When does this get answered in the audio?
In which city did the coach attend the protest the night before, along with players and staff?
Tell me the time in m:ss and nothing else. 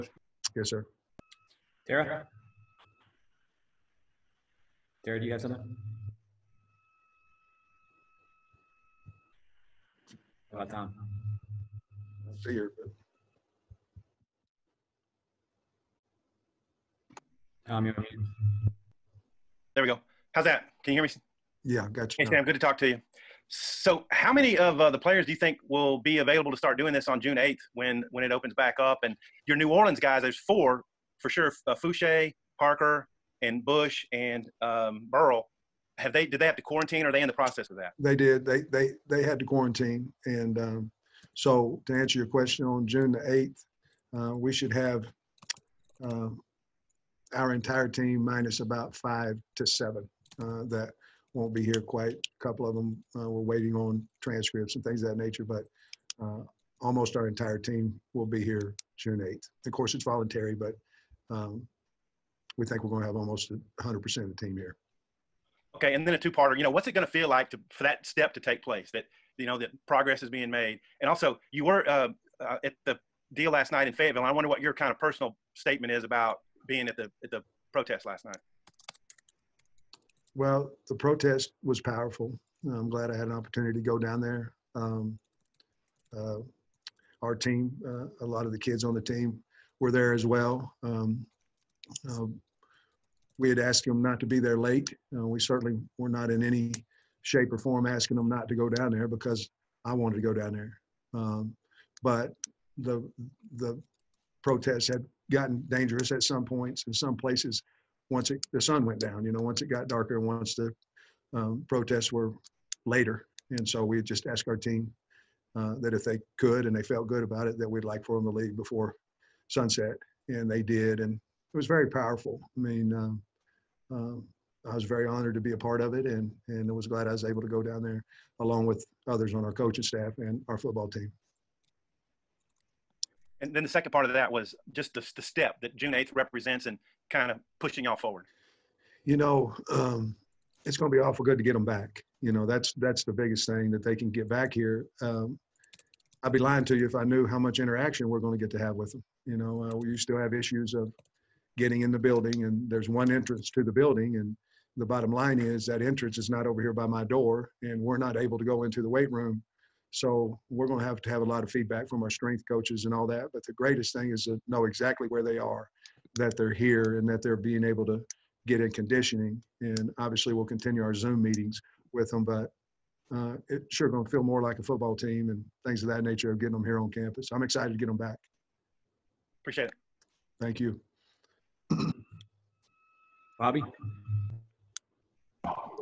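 1:13.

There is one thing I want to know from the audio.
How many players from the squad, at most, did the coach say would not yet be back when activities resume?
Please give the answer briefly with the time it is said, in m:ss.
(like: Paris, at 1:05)
7, at 0:49.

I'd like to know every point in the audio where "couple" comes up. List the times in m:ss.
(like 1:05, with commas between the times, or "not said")
0:52.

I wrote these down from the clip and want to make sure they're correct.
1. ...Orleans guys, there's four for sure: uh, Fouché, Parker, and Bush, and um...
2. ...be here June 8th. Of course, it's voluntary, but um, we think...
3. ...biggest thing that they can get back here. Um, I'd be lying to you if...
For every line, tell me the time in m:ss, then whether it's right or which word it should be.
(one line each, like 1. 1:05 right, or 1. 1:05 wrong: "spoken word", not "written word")
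1. 0:29 right
2. 0:58 right
3. 2:23 right.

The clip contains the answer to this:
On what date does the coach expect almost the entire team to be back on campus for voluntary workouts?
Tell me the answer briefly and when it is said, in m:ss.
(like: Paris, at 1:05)
June 8th, at 0:42.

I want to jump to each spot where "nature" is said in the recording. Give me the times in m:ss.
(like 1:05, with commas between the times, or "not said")
0:55, 2:56.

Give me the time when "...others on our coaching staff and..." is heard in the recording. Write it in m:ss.
2:09.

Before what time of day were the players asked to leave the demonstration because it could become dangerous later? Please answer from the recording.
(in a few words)
sunset.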